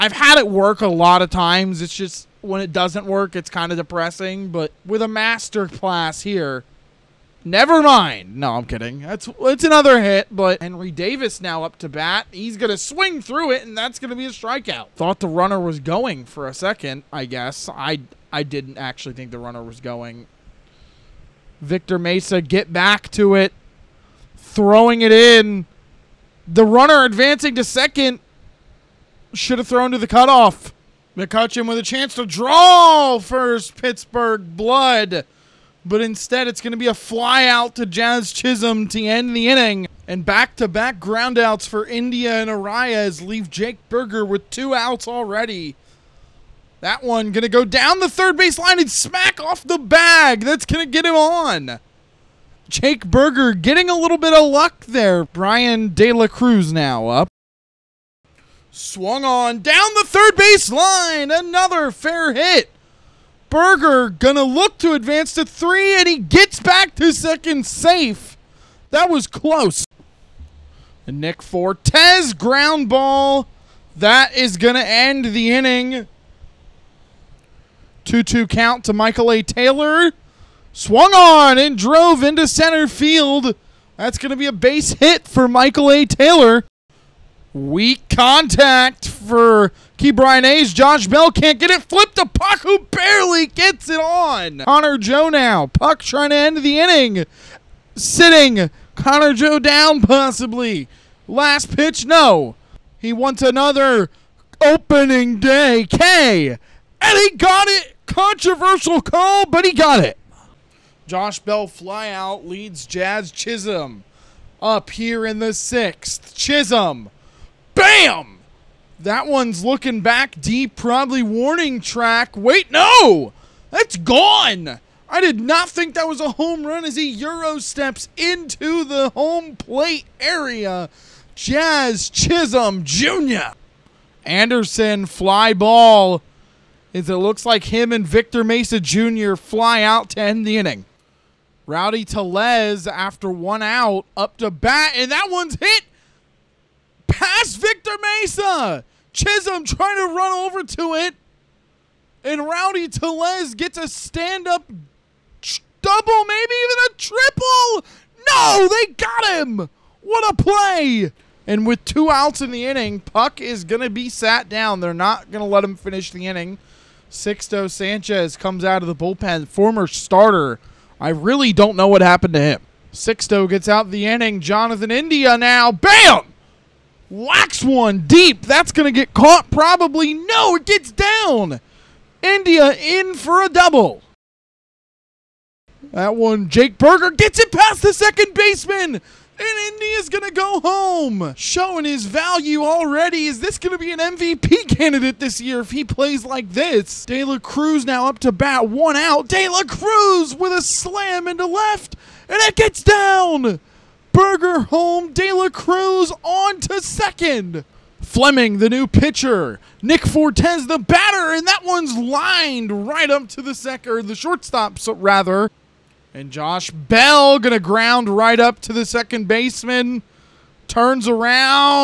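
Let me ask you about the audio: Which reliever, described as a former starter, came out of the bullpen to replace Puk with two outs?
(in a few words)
Sixto Sanchez.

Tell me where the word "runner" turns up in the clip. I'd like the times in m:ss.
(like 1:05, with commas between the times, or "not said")
0:15, 0:19, 0:26.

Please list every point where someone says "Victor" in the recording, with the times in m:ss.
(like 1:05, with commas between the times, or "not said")
0:21, 2:18, 2:27.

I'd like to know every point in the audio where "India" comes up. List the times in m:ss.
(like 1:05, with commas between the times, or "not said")
0:41, 2:54, 3:02, 3:09.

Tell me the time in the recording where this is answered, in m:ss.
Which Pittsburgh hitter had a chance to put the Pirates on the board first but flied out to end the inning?
0:31.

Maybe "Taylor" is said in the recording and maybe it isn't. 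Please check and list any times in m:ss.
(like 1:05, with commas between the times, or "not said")
1:19, 1:26.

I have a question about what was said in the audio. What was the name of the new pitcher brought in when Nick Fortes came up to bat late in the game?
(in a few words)
Fleming.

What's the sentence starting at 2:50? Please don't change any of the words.
I really don't know what happened to him.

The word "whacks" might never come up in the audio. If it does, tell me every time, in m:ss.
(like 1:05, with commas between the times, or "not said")
2:57.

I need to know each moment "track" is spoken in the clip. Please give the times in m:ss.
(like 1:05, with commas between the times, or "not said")
2:01.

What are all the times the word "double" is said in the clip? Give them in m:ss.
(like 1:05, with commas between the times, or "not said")
2:35, 3:03.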